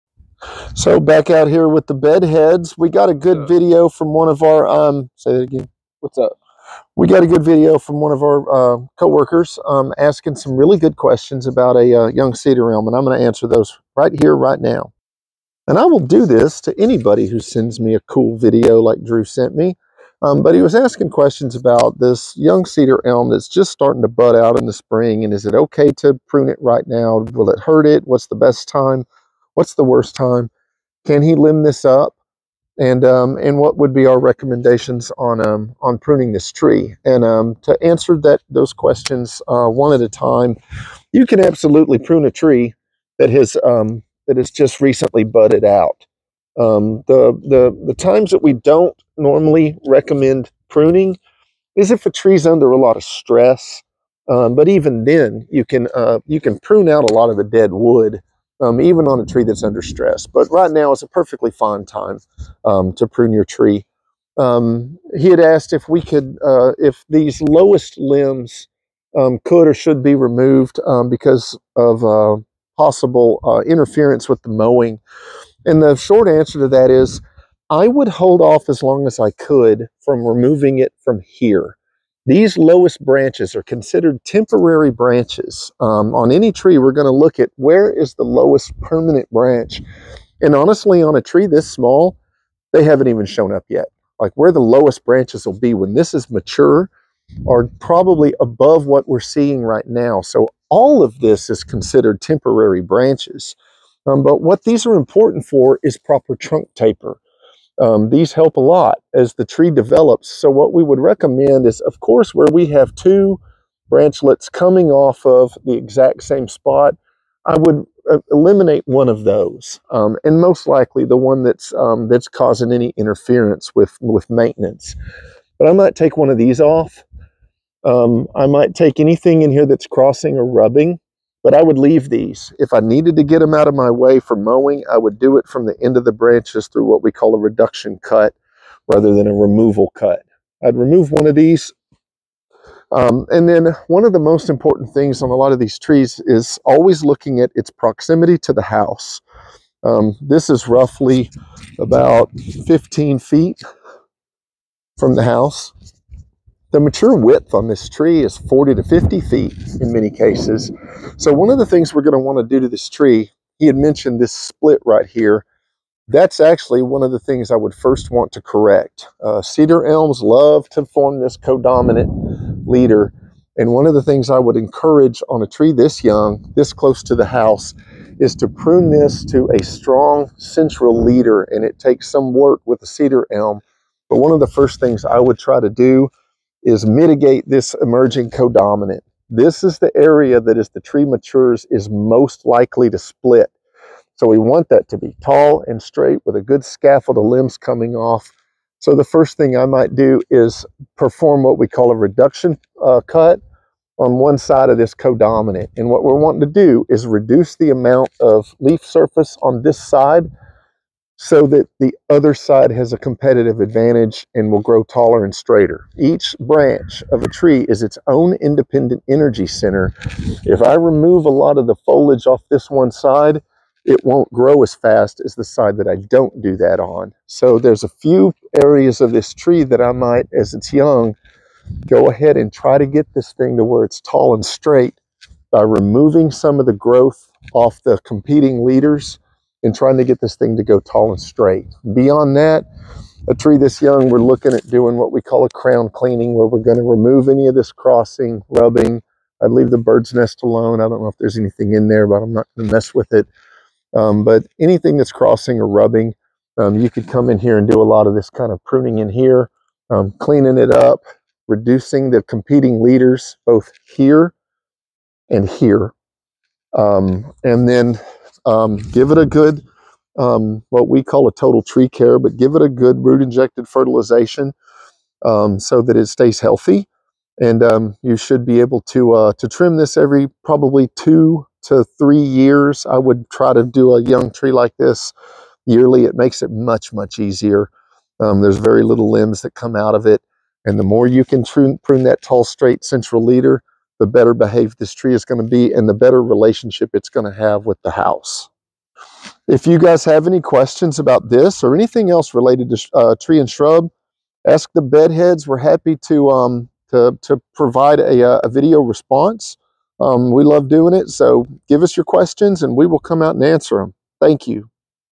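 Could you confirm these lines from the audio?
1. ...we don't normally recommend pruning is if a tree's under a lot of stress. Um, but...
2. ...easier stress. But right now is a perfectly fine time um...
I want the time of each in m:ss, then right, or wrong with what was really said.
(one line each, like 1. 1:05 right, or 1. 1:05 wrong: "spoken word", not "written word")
1. 0:48 right
2. 0:59 wrong: "under", not "easier".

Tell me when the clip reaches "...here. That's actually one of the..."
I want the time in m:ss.
2:45.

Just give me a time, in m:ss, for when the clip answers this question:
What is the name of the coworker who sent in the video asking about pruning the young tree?
0:19.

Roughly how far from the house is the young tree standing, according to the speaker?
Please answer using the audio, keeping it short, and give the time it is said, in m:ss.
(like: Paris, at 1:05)
15 feet, at 2:32.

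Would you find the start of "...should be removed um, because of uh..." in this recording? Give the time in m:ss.
1:09.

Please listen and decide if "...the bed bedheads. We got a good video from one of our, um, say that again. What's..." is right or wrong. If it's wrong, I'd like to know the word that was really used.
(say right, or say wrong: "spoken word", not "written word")
wrong: "heads", not "bedheads".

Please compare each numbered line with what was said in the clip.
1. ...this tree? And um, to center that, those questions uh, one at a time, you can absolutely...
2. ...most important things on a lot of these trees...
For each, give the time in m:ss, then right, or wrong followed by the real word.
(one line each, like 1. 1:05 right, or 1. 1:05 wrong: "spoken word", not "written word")
1. 0:36 wrong: "answer", not "center"
2. 2:24 right.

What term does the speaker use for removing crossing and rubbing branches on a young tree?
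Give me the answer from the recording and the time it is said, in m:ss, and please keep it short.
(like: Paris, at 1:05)
Crown cleaning, at 4:05.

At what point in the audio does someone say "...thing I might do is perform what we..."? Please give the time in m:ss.
3:19.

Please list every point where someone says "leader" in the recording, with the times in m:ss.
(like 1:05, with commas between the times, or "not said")
2:52, 3:01, 3:58, 4:22, 4:53.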